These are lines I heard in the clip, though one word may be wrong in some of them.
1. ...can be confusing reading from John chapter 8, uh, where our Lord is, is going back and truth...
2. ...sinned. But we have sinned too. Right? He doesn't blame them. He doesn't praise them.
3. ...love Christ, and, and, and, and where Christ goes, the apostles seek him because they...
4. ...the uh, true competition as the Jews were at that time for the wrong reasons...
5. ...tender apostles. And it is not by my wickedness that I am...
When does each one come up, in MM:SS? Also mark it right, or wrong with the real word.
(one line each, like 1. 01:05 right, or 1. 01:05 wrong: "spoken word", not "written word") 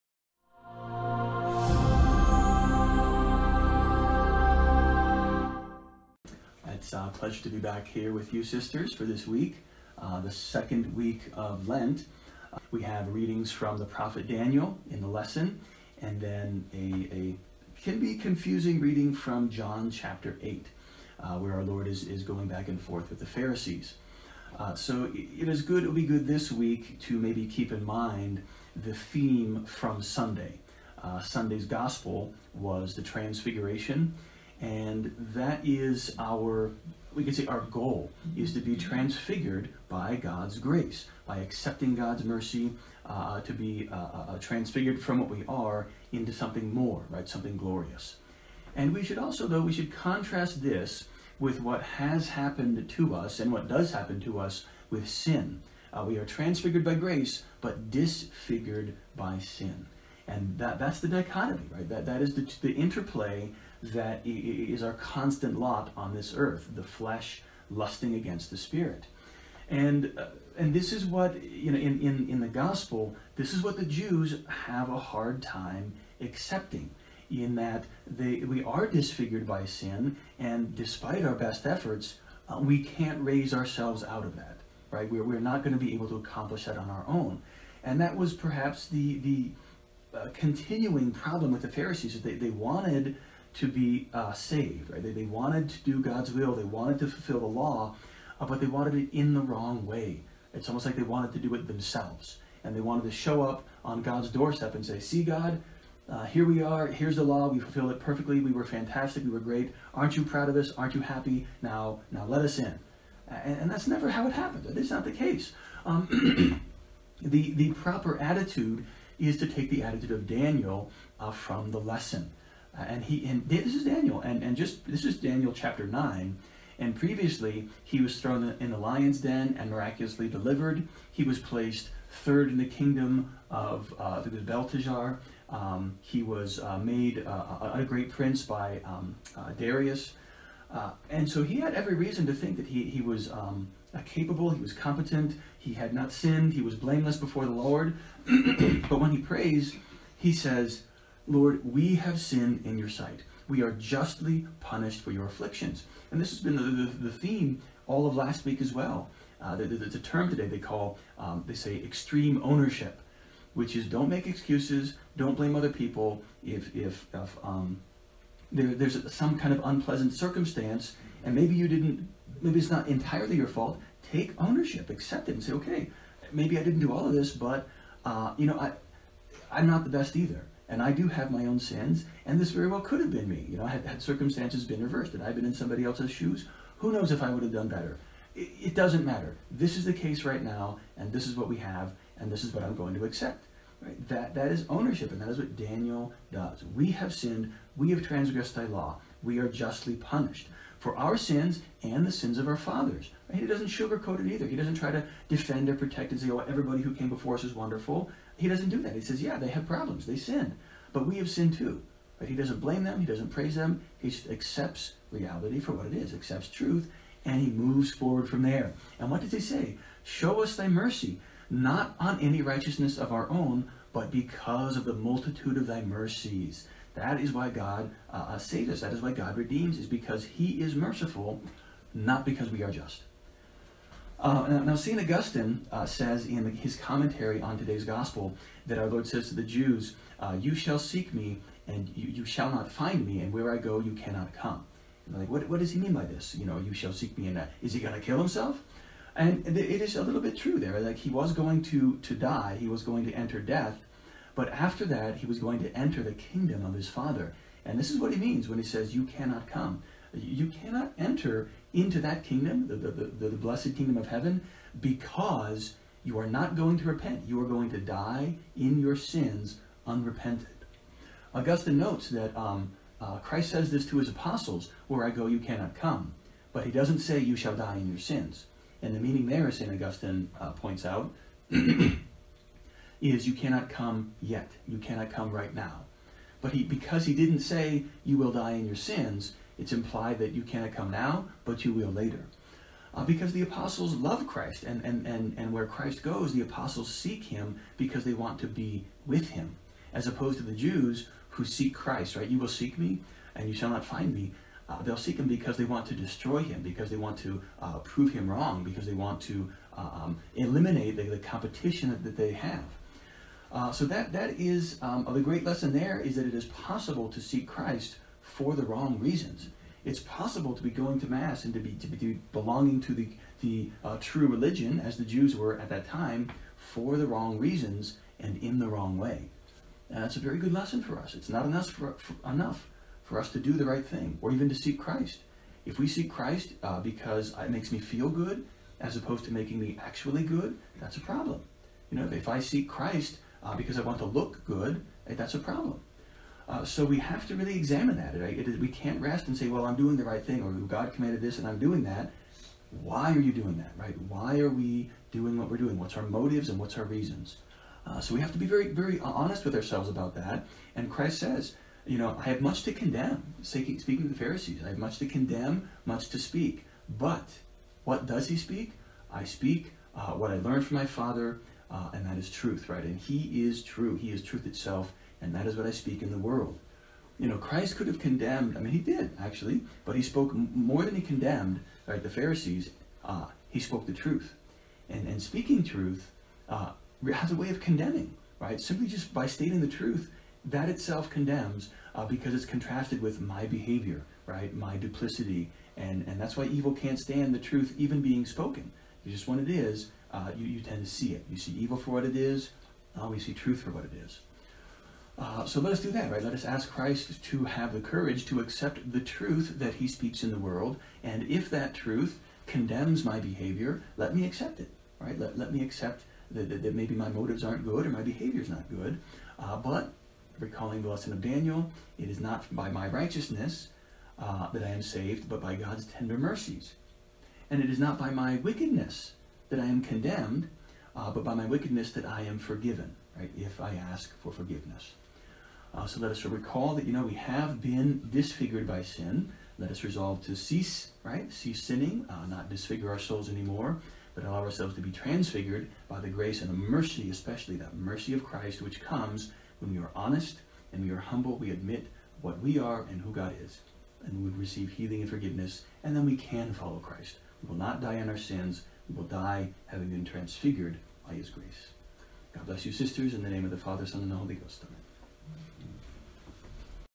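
1. 00:17 wrong: "forth", not "truth"
2. 03:30 right
3. 04:53 right
4. 05:23 wrong: "religion", not "competition"
5. 07:05 wrong: "mercies", not "apostles".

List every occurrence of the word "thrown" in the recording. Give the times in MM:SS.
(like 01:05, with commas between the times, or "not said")
02:08.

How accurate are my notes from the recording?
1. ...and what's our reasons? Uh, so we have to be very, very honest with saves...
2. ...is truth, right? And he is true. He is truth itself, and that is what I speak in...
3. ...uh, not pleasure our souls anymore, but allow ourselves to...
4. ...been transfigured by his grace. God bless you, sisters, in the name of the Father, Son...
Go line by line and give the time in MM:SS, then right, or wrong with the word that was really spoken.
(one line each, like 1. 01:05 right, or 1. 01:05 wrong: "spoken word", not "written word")
1. 05:56 wrong: "ourselves", not "saves"
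2. 06:12 right
3. 07:22 wrong: "disfigure", not "pleasure"
4. 07:39 right.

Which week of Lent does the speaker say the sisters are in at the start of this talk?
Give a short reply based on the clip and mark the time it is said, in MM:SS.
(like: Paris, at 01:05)
Second week, at 00:10.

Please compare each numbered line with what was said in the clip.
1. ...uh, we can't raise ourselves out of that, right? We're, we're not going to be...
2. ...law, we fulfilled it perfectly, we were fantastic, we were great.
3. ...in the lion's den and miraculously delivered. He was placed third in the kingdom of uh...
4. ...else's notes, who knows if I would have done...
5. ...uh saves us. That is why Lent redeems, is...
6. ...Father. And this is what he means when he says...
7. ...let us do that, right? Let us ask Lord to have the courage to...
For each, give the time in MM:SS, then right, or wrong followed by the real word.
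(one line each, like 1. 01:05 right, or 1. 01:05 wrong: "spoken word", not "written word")
1. 01:22 right
2. 01:47 right
3. 02:08 right
4. 03:05 wrong: "shoes", not "notes"
5. 03:48 wrong: "God", not "Lent"
6. 04:16 right
7. 06:45 wrong: "Christ", not "Lord".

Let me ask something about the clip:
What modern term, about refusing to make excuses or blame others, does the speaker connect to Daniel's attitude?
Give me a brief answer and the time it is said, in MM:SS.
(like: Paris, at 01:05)
Extreme ownership, at 02:41.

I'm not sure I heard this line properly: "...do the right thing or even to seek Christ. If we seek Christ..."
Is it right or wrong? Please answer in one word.
right.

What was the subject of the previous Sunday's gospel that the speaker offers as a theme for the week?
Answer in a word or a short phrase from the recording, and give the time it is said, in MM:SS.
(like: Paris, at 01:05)
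The transfiguration, at 00:32.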